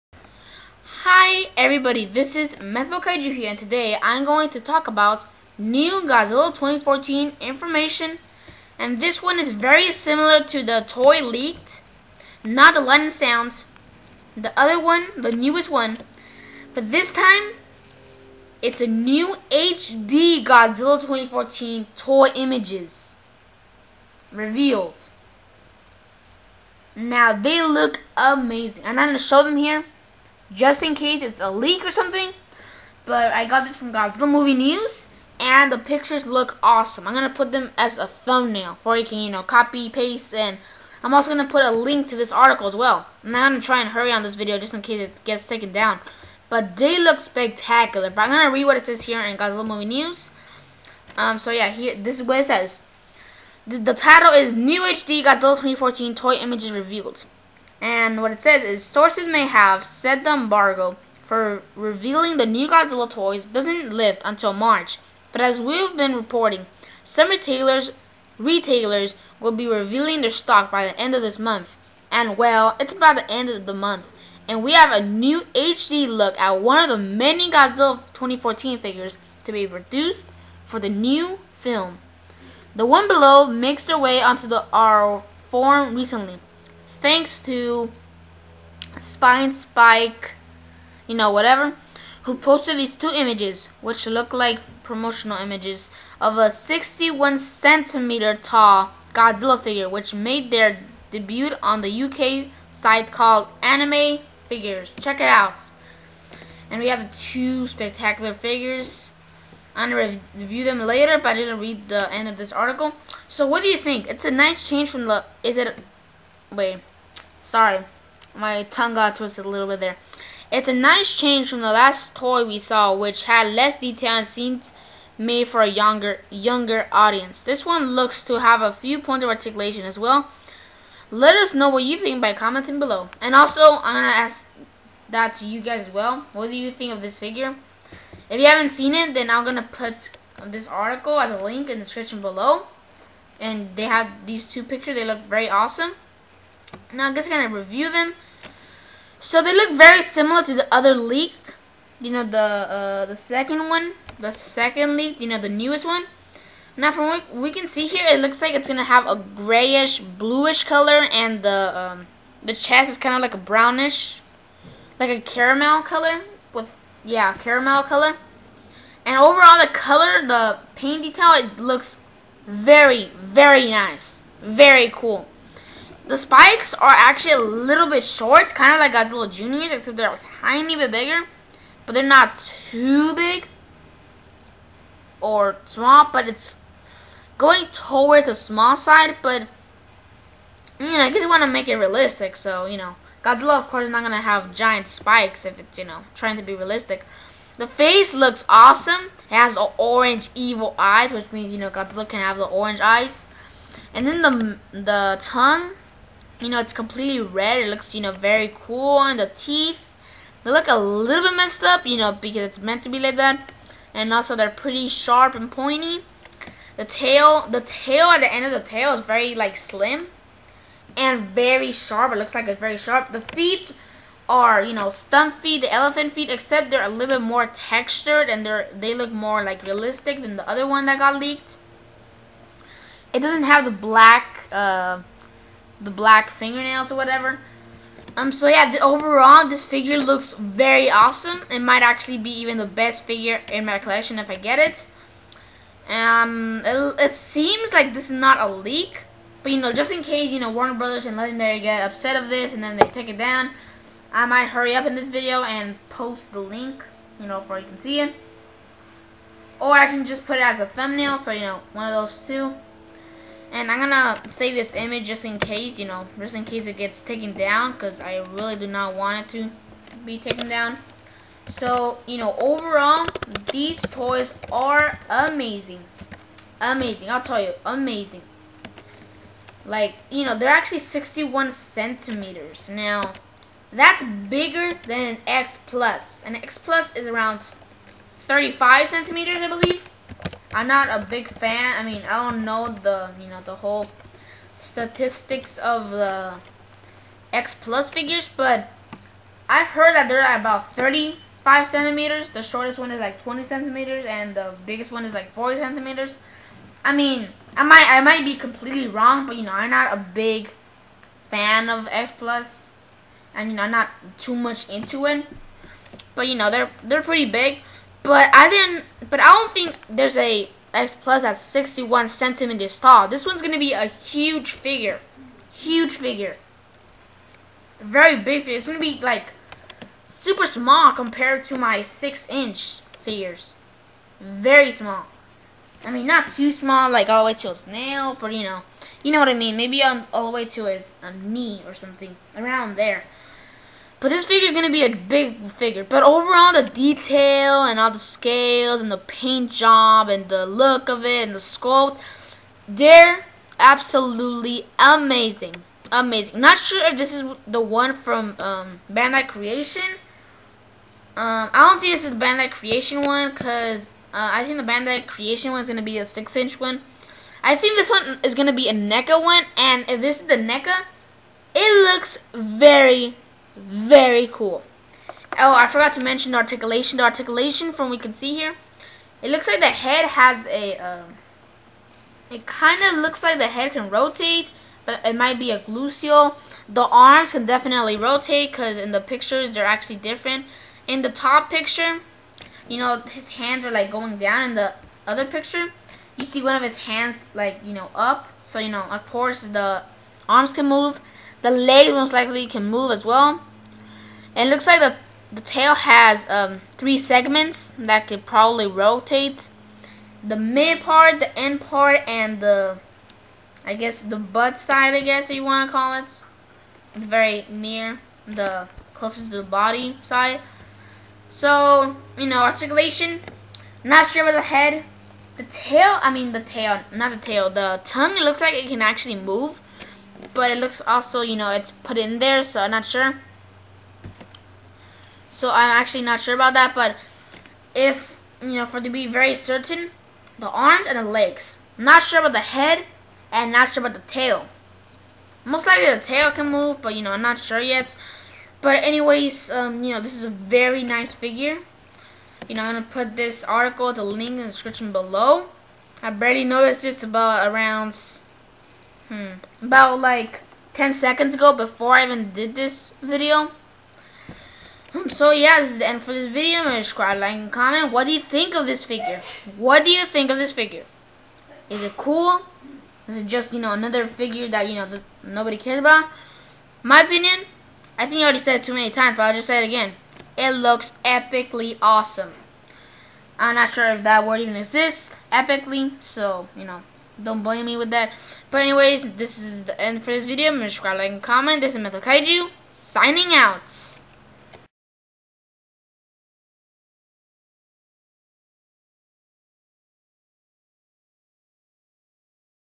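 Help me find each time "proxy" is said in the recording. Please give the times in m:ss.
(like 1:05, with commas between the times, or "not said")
not said.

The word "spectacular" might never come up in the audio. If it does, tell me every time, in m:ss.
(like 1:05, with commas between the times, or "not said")
0:47, 1:47.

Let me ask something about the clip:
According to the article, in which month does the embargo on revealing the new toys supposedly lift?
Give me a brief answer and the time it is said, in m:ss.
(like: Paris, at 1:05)
March, at 1:04.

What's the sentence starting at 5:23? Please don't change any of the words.
This one's going to be a huge figure.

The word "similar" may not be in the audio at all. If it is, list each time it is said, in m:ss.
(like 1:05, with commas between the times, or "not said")
0:09, 2:30.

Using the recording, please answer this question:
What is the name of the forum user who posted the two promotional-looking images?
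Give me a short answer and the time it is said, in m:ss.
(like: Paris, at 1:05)
Spine Spike, at 1:28.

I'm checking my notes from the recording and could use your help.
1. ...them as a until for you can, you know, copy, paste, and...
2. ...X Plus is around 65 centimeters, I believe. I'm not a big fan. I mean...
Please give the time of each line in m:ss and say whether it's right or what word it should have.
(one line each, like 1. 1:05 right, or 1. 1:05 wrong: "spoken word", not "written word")
1. 0:37 wrong: "thumbnail", not "until"
2. 4:46 wrong: "35", not "65".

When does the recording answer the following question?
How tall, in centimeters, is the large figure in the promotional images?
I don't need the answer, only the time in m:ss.
1:36.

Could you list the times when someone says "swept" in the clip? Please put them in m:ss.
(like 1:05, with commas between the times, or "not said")
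not said.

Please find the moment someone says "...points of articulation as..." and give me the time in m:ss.
2:08.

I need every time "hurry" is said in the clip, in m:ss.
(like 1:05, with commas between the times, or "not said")
0:43, 4:14.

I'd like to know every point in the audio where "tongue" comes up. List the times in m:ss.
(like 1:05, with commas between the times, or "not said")
1:58, 3:25, 7:07.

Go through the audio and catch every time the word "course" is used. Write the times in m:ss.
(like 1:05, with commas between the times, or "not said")
3:13, 6:39.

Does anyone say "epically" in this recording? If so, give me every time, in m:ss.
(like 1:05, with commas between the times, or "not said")
8:01, 8:05.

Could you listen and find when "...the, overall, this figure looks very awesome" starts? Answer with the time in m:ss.
3:58.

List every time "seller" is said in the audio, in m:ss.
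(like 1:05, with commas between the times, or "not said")
not said.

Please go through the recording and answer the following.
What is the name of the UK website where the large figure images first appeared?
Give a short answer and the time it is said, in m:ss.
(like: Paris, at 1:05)
Anime Figures, at 1:43.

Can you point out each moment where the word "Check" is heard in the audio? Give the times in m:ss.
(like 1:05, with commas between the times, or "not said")
1:45.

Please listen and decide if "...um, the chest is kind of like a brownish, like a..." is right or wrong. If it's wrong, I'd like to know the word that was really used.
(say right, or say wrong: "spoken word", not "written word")
right.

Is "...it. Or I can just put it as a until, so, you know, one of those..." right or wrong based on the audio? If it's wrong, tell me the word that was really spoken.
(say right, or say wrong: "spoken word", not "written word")
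wrong: "thumbnail", not "until".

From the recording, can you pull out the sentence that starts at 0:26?
Now they look amazing and I'm going to show them here just in case it's a leak or something.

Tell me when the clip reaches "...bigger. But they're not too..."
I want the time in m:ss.
3:00.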